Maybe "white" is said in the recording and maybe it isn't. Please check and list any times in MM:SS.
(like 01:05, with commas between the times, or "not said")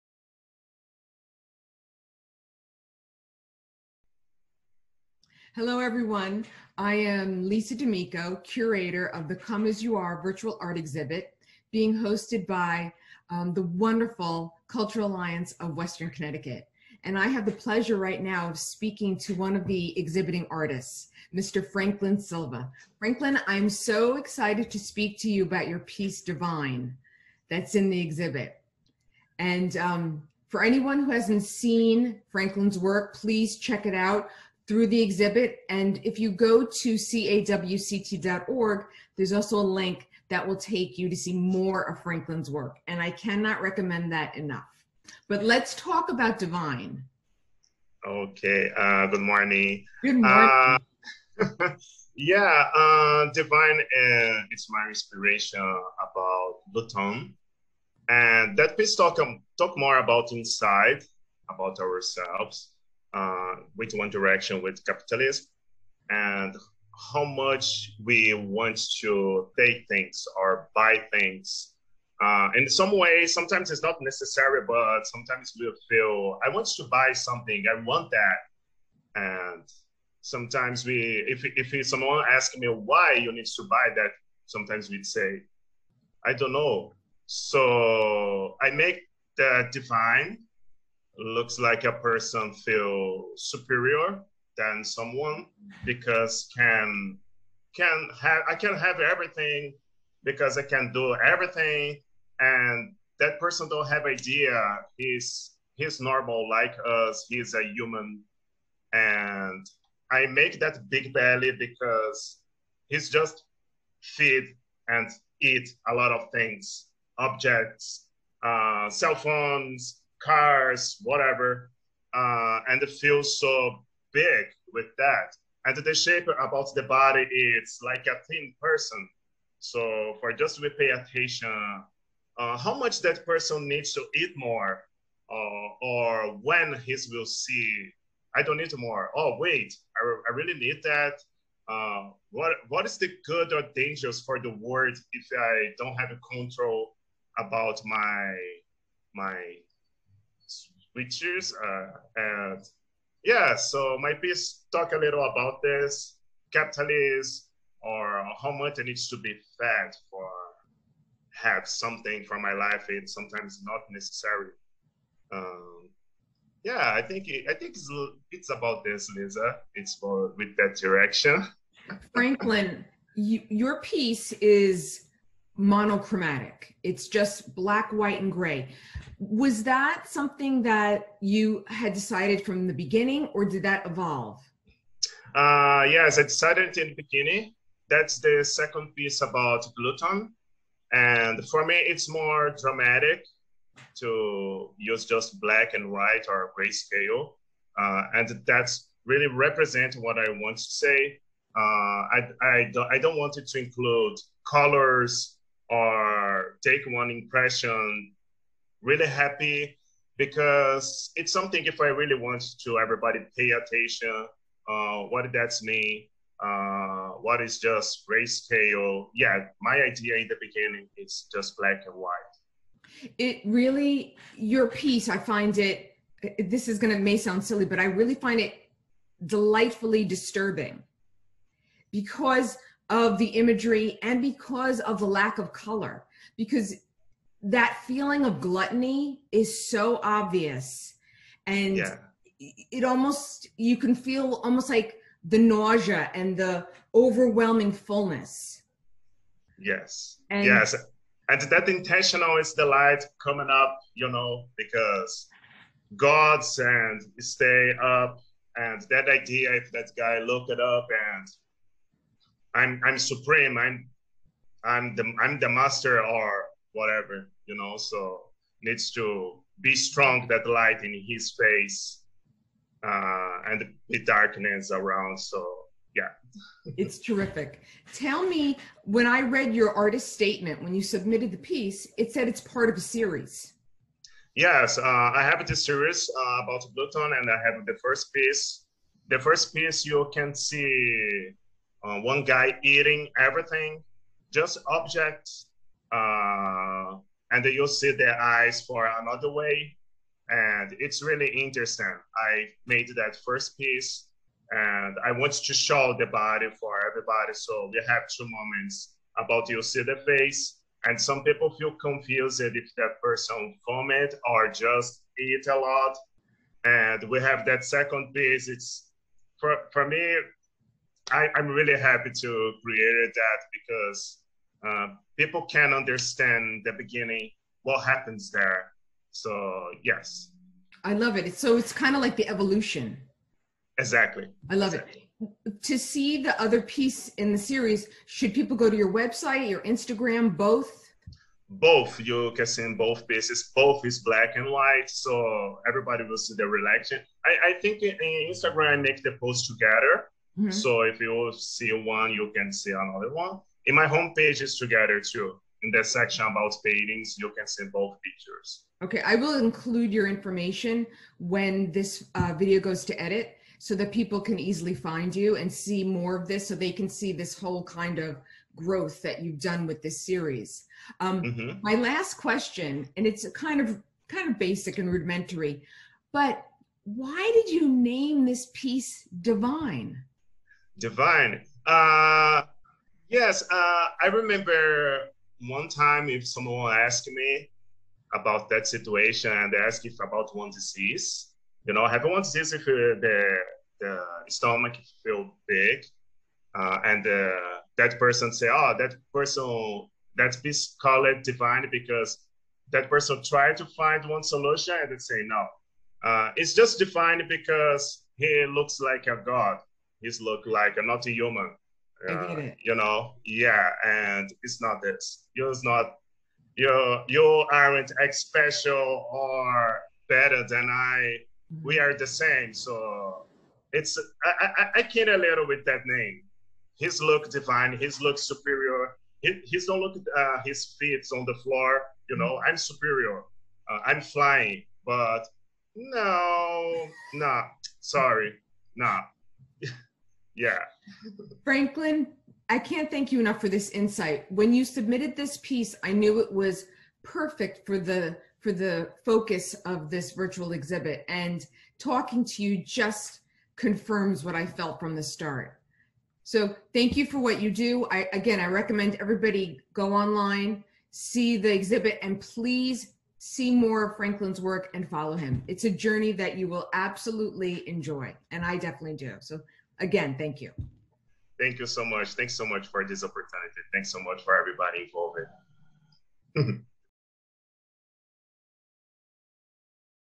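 02:57, 03:15, 03:41, 05:44.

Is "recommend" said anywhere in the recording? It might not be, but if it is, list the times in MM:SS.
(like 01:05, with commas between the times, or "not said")
00:43, 07:38.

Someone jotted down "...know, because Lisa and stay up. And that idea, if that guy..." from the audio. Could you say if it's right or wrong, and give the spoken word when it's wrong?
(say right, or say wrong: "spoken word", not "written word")
wrong: "God", not "Lisa".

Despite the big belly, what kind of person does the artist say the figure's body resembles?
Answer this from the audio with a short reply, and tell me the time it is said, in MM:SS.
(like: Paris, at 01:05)
A thin person, at 02:08.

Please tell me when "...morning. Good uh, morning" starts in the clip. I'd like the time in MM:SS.
00:49.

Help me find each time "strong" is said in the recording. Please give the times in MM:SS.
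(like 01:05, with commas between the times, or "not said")
04:29.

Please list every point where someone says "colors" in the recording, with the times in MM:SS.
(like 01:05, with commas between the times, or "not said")
03:24, 03:55.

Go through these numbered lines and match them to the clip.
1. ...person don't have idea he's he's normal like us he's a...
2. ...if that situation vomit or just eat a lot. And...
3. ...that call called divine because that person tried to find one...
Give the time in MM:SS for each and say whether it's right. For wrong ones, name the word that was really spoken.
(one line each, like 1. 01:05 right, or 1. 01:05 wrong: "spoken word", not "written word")
1. 01:43 right
2. 05:12 wrong: "person", not "situation"
3. 06:40 right.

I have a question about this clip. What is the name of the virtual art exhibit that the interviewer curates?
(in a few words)
Come As You Are.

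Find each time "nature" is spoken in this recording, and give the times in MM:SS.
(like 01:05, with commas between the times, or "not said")
not said.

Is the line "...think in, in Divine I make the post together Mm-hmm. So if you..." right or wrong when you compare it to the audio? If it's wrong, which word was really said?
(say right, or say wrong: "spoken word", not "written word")
wrong: "Instagram", not "Divine".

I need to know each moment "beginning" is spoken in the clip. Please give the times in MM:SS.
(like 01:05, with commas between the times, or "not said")
03:02, 03:06, 03:40, 05:26.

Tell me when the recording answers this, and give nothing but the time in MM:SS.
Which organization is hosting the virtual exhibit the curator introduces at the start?
00:14.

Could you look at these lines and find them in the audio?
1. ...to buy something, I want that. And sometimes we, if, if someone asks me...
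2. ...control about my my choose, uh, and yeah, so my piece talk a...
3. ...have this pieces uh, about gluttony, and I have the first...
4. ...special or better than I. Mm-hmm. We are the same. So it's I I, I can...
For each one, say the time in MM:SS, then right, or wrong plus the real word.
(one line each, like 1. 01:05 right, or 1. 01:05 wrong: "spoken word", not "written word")
1. 01:16 right
2. 02:26 right
3. 04:45 wrong: "series", not "pieces"
4. 06:58 right.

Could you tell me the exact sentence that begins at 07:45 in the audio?
It's a journey that you will absolutely enjoy, and I definitely do.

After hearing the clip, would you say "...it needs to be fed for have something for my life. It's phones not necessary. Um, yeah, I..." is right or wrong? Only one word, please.
wrong.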